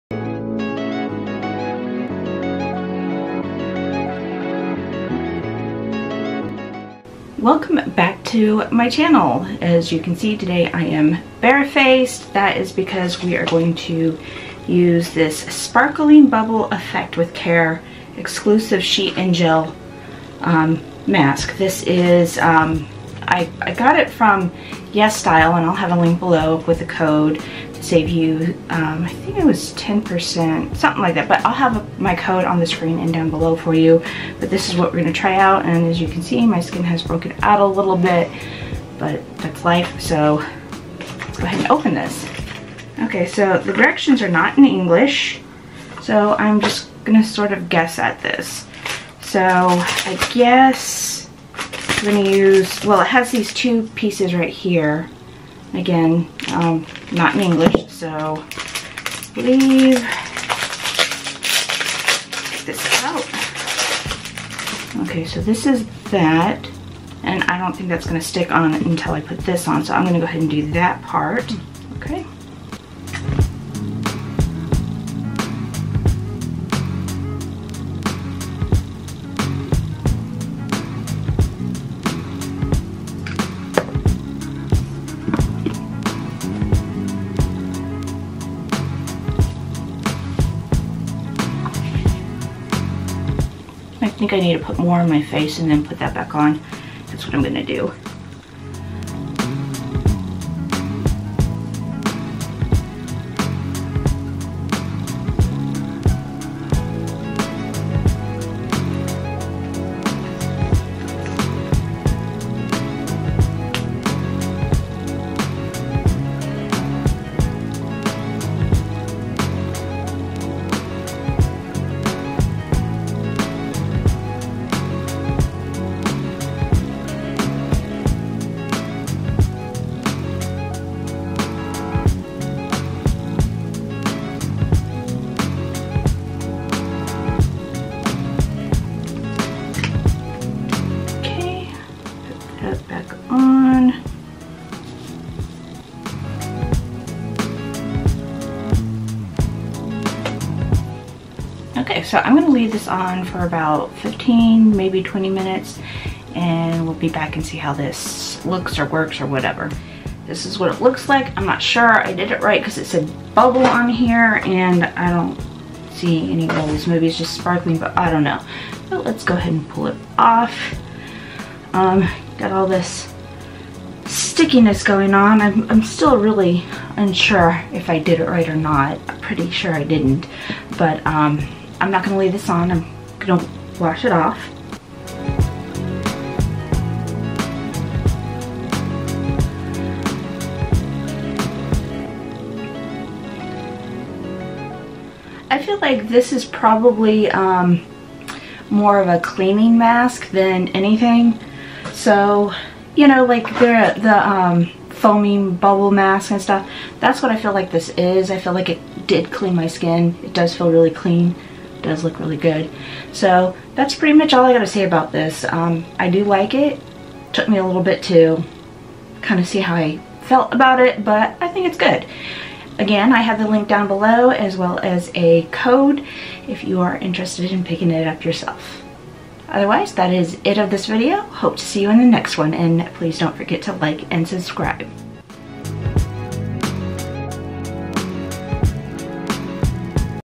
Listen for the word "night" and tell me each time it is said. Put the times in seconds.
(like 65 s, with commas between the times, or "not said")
not said.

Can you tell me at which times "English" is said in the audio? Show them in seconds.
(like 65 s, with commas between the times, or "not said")
44 s, 57 s.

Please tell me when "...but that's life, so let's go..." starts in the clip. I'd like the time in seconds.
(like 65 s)
38 s.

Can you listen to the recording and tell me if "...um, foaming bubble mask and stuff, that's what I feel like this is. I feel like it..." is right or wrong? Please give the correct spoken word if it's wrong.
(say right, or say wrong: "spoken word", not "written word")
right.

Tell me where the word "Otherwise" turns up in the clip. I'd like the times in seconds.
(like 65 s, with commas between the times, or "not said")
229 s.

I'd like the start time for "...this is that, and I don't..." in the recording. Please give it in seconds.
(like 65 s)
65 s.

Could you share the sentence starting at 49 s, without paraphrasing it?
So I guess I'm going to use, well, it has these two pieces right here.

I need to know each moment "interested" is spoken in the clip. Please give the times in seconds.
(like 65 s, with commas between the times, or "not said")
226 s.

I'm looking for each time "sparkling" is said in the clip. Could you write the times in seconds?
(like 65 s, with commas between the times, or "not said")
15 s, 167 s.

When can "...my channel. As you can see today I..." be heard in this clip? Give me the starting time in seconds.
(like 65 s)
8 s.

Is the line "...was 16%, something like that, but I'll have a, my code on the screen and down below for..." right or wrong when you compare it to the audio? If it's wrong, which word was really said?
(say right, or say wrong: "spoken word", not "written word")
wrong: "10", not "16".